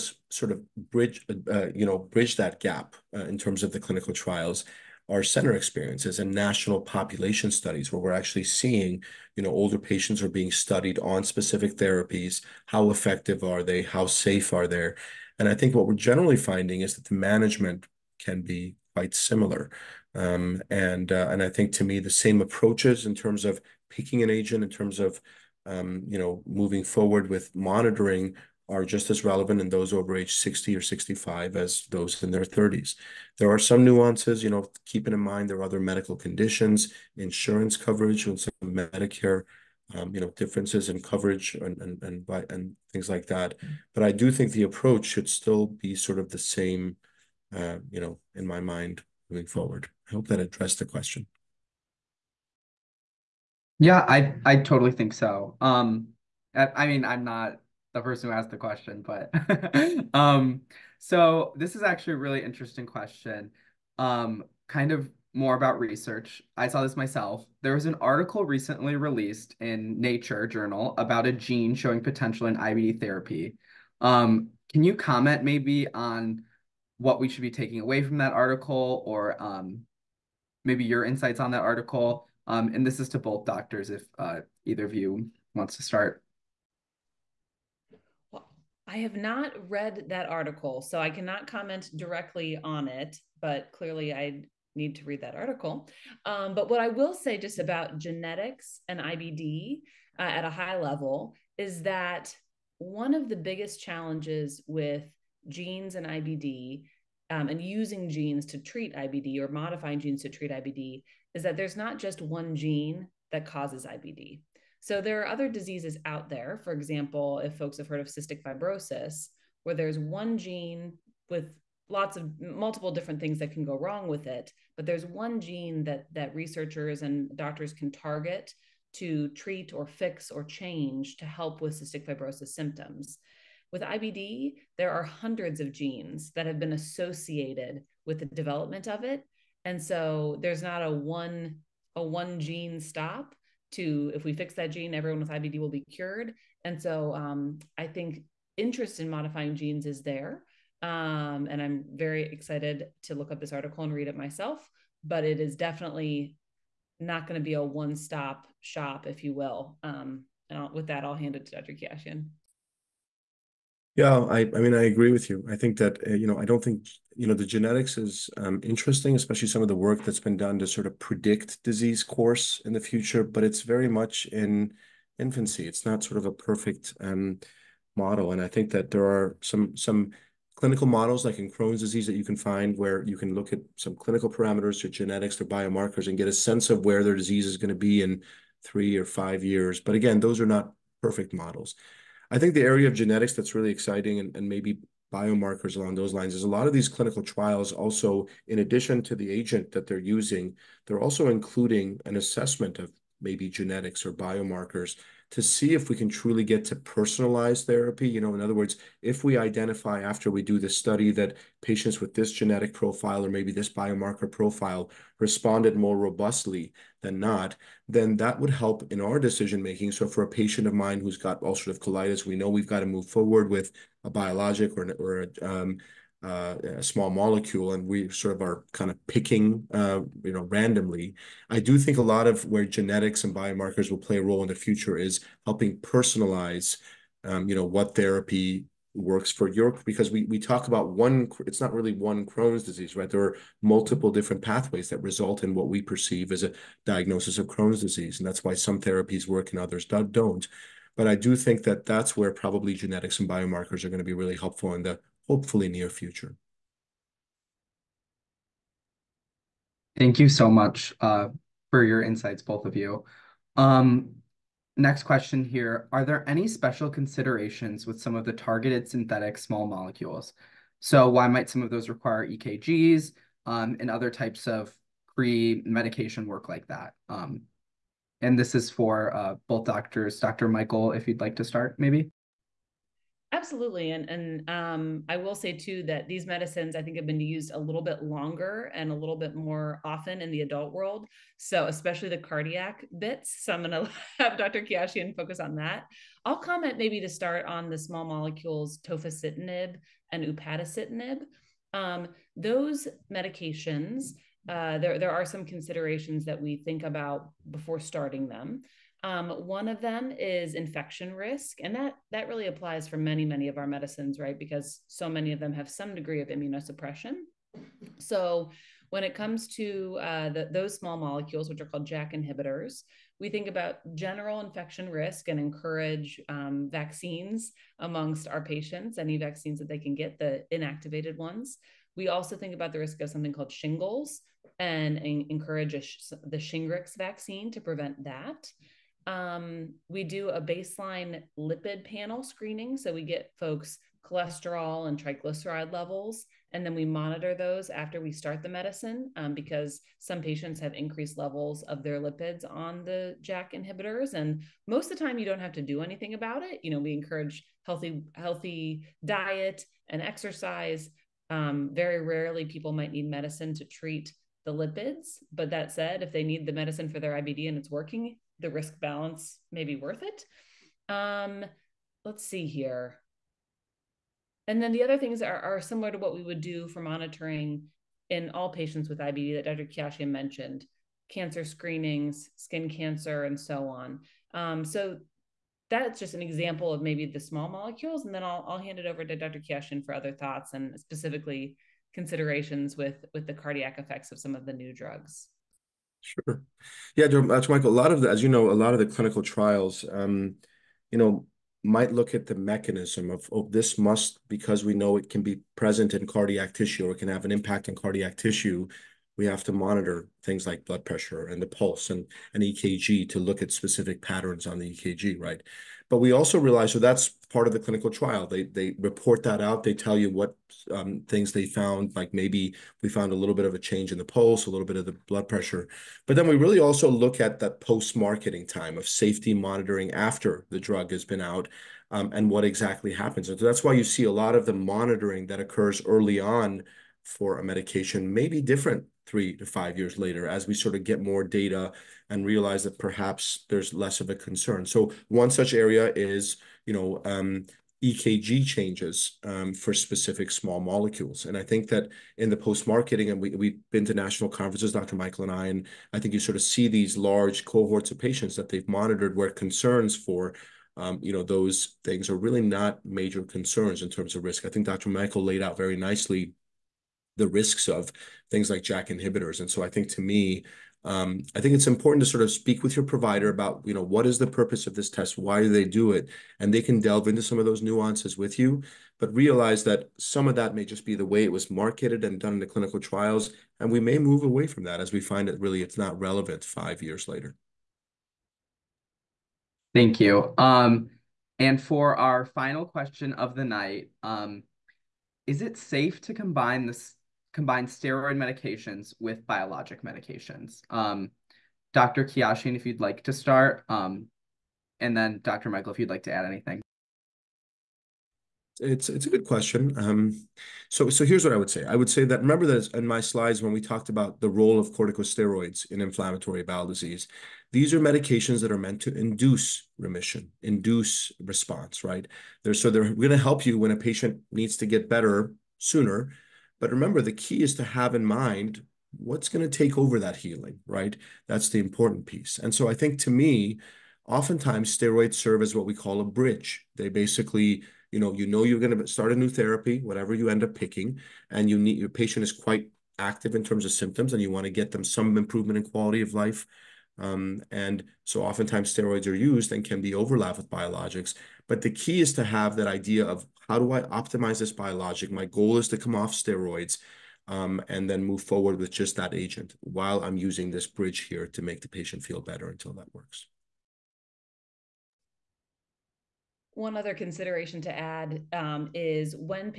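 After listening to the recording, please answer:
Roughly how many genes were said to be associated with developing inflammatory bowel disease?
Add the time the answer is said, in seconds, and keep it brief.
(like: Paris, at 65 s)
Hundreds, at 135 s.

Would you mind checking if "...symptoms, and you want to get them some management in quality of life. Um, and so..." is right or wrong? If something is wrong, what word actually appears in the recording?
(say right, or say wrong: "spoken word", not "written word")
wrong: "improvement", not "management".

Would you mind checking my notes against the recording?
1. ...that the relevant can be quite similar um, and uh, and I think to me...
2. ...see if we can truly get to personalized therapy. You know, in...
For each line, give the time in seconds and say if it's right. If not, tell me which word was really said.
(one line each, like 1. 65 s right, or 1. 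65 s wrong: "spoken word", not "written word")
1. 16 s wrong: "management", not "relevant"
2. 205 s right.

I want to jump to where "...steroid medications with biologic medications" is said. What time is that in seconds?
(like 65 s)
497 s.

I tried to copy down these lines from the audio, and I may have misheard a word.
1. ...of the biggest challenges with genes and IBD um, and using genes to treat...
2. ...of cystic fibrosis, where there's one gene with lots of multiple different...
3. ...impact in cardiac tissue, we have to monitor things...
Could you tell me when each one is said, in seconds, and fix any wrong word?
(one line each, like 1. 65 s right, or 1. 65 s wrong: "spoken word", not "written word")
1. 103 s right
2. 118 s right
3. 407 s right.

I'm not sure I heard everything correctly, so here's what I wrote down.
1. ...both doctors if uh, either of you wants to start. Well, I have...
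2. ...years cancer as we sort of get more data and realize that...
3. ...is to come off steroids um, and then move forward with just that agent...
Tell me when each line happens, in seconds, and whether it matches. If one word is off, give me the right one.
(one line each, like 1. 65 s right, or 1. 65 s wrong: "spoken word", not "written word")
1. 83 s right
2. 439 s wrong: "later", not "cancer"
3. 555 s right.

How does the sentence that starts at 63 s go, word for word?
Um, kind of more about research.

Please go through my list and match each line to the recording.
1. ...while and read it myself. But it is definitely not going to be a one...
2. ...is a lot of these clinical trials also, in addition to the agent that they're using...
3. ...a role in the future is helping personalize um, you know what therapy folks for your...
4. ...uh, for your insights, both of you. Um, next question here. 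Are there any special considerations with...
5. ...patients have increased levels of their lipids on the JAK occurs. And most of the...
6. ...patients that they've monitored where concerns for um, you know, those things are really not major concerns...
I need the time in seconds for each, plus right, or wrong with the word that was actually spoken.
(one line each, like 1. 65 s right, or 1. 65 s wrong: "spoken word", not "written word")
1. 153 s wrong: "article", not "while"
2. 196 s right
3. 234 s wrong: "works", not "folks"
4. 260 s right
5. 350 s wrong: "inhibitors", not "occurs"
6. 457 s right.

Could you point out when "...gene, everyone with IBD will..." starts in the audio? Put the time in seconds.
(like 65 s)
144 s.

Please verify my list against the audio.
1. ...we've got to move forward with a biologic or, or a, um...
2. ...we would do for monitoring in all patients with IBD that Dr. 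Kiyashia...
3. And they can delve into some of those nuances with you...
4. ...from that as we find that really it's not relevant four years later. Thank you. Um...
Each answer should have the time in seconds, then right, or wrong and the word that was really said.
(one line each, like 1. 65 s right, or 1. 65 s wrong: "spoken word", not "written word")
1. 222 s right
2. 376 s right
3. 476 s right
4. 484 s wrong: "five", not "four".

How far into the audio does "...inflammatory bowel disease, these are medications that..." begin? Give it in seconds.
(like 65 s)
515 s.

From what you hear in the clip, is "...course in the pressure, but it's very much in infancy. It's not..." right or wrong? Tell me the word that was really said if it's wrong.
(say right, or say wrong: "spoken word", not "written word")
wrong: "future", not "pressure".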